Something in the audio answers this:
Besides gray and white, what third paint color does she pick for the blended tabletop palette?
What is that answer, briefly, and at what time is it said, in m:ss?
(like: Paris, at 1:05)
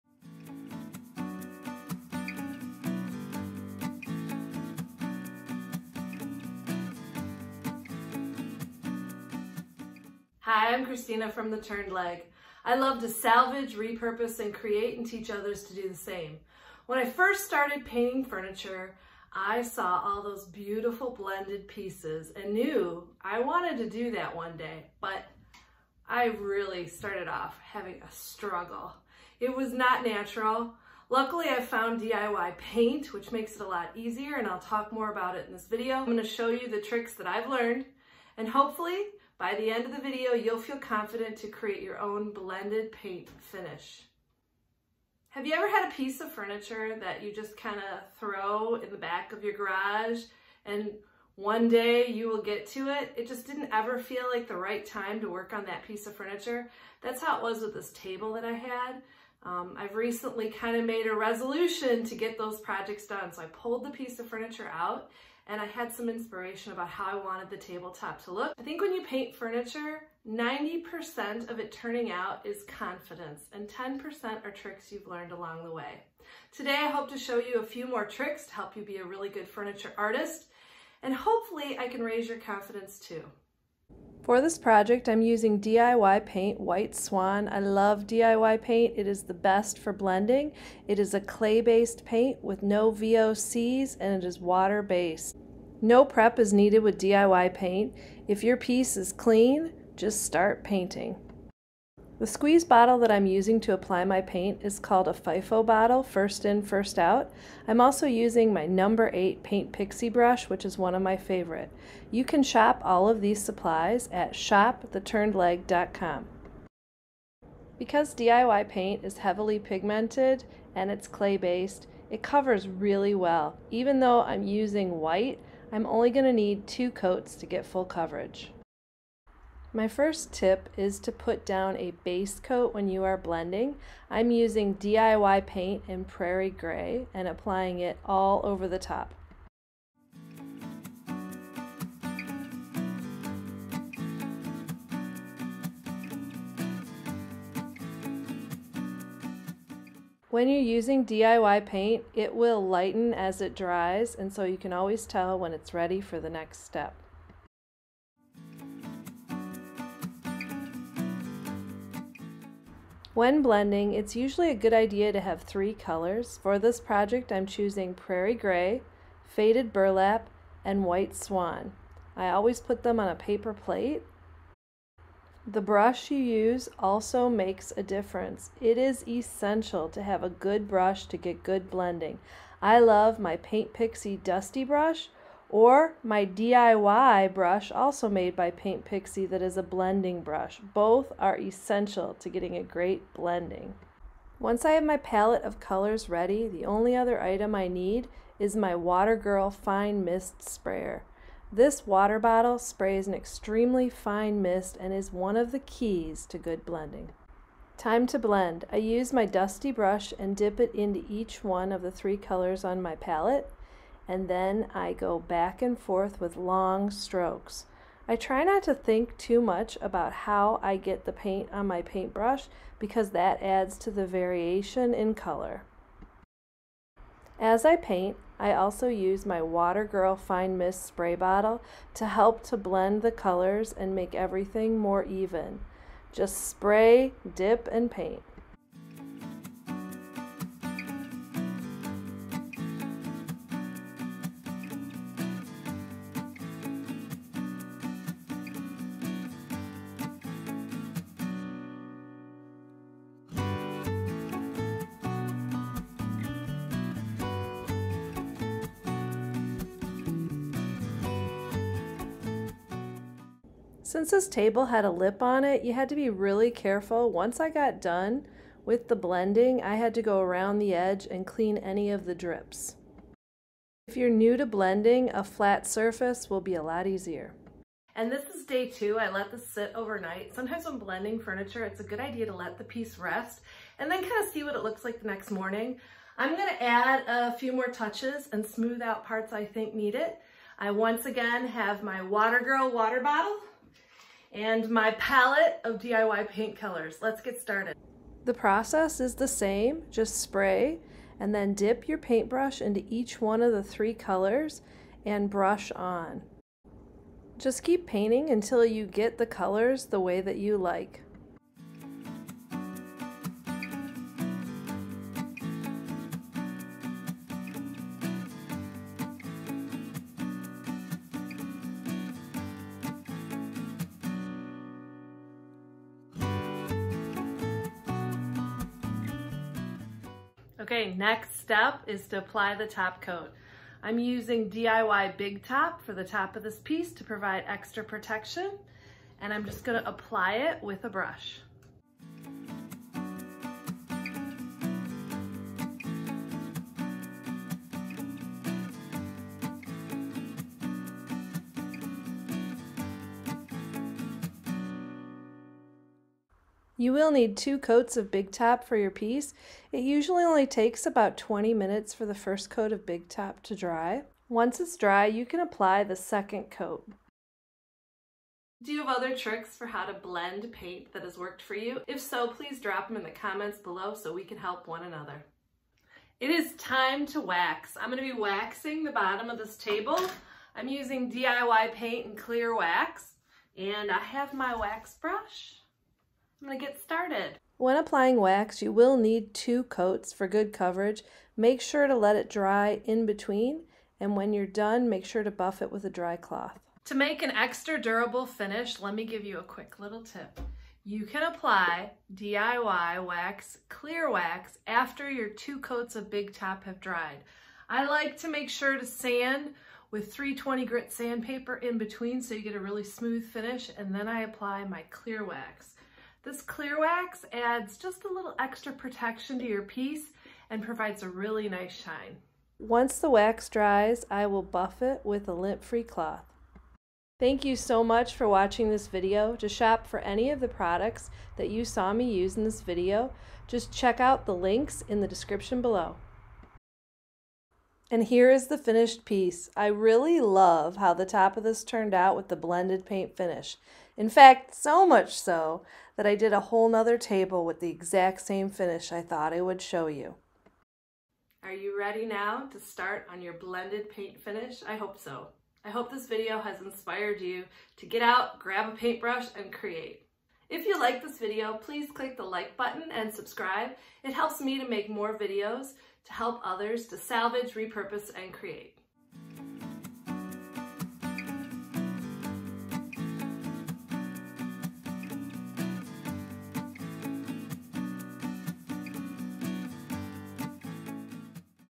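Faded Burlap, at 2:49.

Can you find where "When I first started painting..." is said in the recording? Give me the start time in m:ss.
0:16.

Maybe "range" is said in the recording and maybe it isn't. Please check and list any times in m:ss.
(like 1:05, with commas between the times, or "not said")
not said.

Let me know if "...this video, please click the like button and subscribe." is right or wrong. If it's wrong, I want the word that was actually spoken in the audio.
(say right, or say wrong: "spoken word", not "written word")
right.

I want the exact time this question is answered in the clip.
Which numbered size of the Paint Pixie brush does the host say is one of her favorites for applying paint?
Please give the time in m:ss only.
1:48.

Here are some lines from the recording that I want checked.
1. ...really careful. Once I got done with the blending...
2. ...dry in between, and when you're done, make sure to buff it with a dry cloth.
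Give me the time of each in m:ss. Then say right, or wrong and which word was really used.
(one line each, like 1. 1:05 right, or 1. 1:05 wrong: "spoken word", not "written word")
1. 4:26 right
2. 6:32 right.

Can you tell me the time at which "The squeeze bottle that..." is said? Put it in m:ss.
1:42.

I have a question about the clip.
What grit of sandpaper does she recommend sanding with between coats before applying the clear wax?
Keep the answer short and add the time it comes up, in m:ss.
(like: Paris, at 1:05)
320, at 6:50.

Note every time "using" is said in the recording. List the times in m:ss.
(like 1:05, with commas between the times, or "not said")
1:25, 1:43, 1:48, 2:04, 2:14, 2:30, 5:33, 6:20.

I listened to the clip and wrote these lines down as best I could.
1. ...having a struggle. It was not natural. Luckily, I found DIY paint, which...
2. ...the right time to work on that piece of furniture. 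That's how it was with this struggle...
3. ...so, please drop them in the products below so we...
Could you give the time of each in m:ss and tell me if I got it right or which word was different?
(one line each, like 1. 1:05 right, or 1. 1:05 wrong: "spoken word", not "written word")
1. 0:27 right
2. 0:54 wrong: "table", not "struggle"
3. 6:12 wrong: "comments", not "products".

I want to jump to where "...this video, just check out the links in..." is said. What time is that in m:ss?
7:12.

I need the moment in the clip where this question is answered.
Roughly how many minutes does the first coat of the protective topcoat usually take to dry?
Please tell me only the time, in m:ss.
6:01.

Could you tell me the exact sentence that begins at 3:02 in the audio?
I love my Paint Pixie Dusty brush, or my DIY brush, also made by Paint Pixie, that is a blending brush.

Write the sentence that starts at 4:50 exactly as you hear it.
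I once again have my Water Girl water bottle and my palette of DIY paint colors.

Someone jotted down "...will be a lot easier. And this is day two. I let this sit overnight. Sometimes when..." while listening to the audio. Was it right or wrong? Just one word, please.
right.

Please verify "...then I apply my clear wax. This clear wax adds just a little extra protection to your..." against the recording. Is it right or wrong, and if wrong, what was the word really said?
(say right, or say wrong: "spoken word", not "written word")
right.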